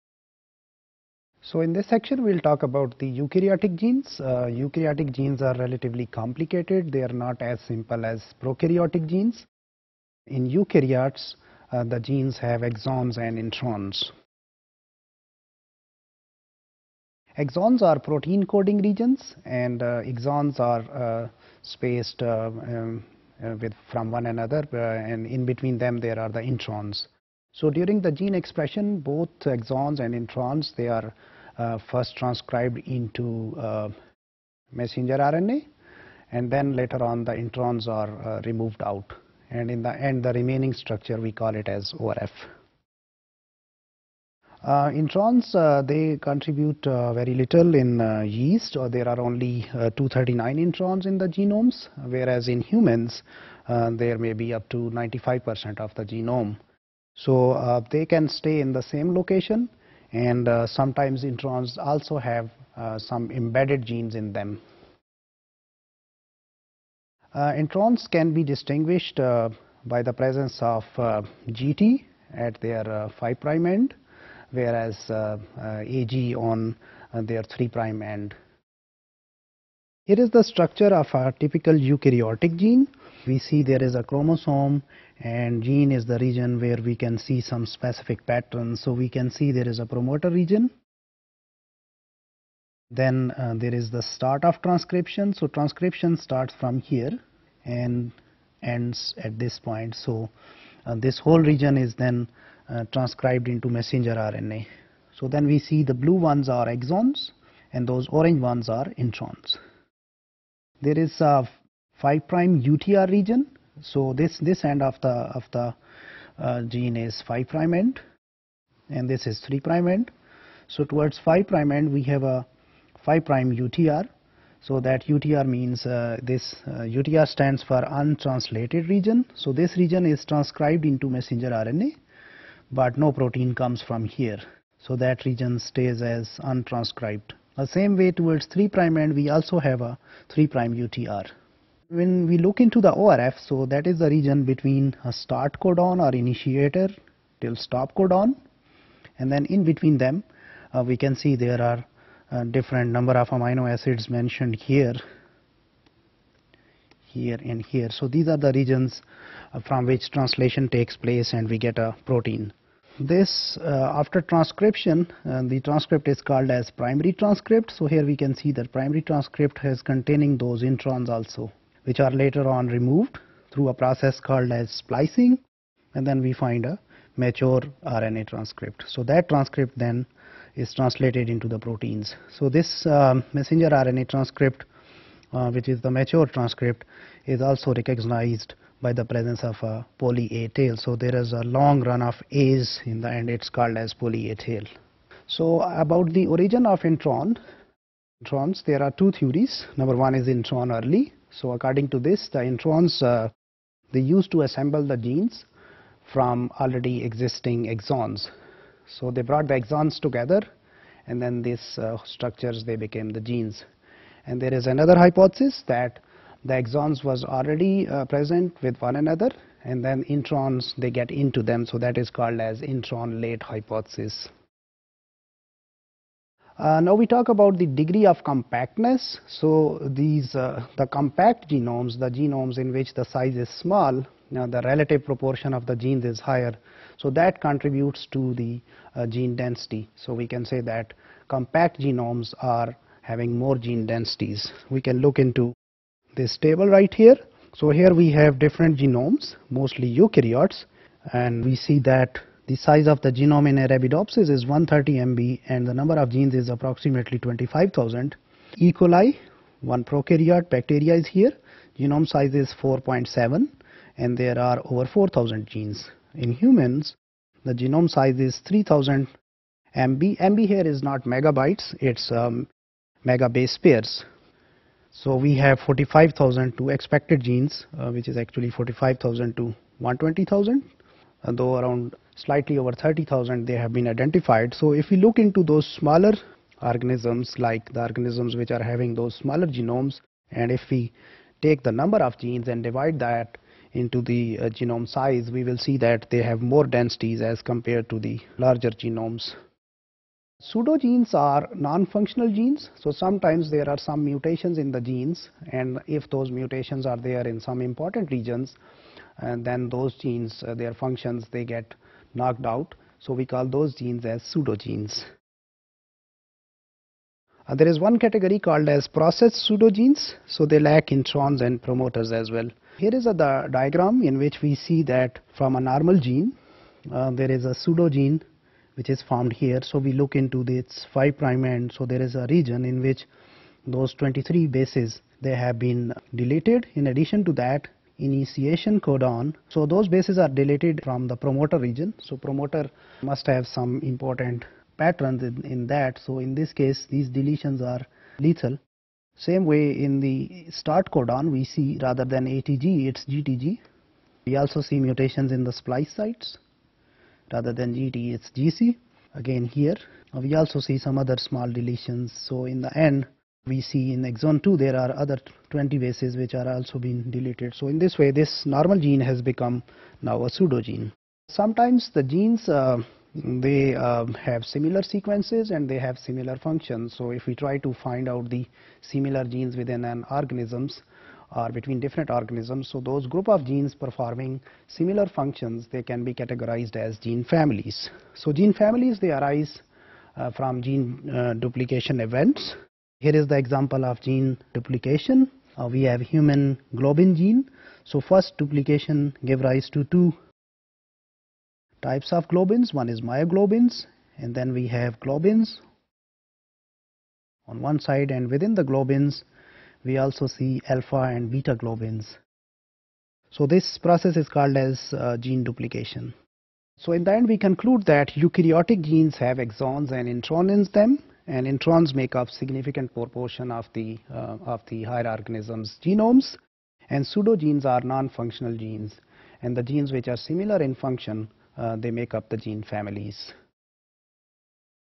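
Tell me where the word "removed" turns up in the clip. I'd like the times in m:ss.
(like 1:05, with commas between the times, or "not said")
0:38, 2:52.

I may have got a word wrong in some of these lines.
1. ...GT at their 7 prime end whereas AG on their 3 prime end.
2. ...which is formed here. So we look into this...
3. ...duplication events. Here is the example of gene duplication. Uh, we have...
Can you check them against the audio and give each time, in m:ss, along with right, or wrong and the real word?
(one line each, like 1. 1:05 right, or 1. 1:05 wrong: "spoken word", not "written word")
1. 1:11 wrong: "5", not "7"
2. 5:28 right
3. 6:31 right.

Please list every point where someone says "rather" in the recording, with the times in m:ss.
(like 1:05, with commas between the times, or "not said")
5:51, 5:57.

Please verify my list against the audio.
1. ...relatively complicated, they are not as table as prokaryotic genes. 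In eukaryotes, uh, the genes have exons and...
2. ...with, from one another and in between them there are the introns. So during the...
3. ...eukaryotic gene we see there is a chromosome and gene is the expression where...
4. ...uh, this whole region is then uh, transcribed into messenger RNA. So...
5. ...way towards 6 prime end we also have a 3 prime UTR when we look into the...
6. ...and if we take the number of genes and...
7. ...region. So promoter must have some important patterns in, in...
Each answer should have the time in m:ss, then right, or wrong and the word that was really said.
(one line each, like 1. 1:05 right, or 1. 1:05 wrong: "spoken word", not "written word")
1. 0:05 wrong: "simple", not "table"
2. 0:23 right
3. 1:21 wrong: "region", not "expression"
4. 1:40 right
5. 2:18 wrong: "3", not "6"
6. 4:50 right
7. 5:41 right.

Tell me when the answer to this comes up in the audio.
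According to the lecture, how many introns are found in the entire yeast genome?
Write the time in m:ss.
0:49.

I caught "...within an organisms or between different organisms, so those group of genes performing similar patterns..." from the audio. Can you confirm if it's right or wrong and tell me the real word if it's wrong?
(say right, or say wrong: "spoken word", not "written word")
wrong: "functions", not "patterns".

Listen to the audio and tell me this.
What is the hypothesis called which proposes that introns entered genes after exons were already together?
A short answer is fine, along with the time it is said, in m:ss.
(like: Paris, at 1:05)
intron late, at 3:42.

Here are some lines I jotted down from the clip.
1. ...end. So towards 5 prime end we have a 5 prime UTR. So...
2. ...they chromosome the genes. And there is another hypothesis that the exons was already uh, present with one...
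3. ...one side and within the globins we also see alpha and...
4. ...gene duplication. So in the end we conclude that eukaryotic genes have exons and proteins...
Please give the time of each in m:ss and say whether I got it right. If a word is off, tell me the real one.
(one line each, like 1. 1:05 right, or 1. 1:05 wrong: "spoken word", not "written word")
1. 1:59 right
2. 3:32 wrong: "became", not "chromosome"
3. 6:47 right
4. 6:55 wrong: "introns", not "proteins".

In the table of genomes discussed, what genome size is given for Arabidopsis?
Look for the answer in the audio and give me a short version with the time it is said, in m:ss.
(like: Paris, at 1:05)
130 MB, at 4:14.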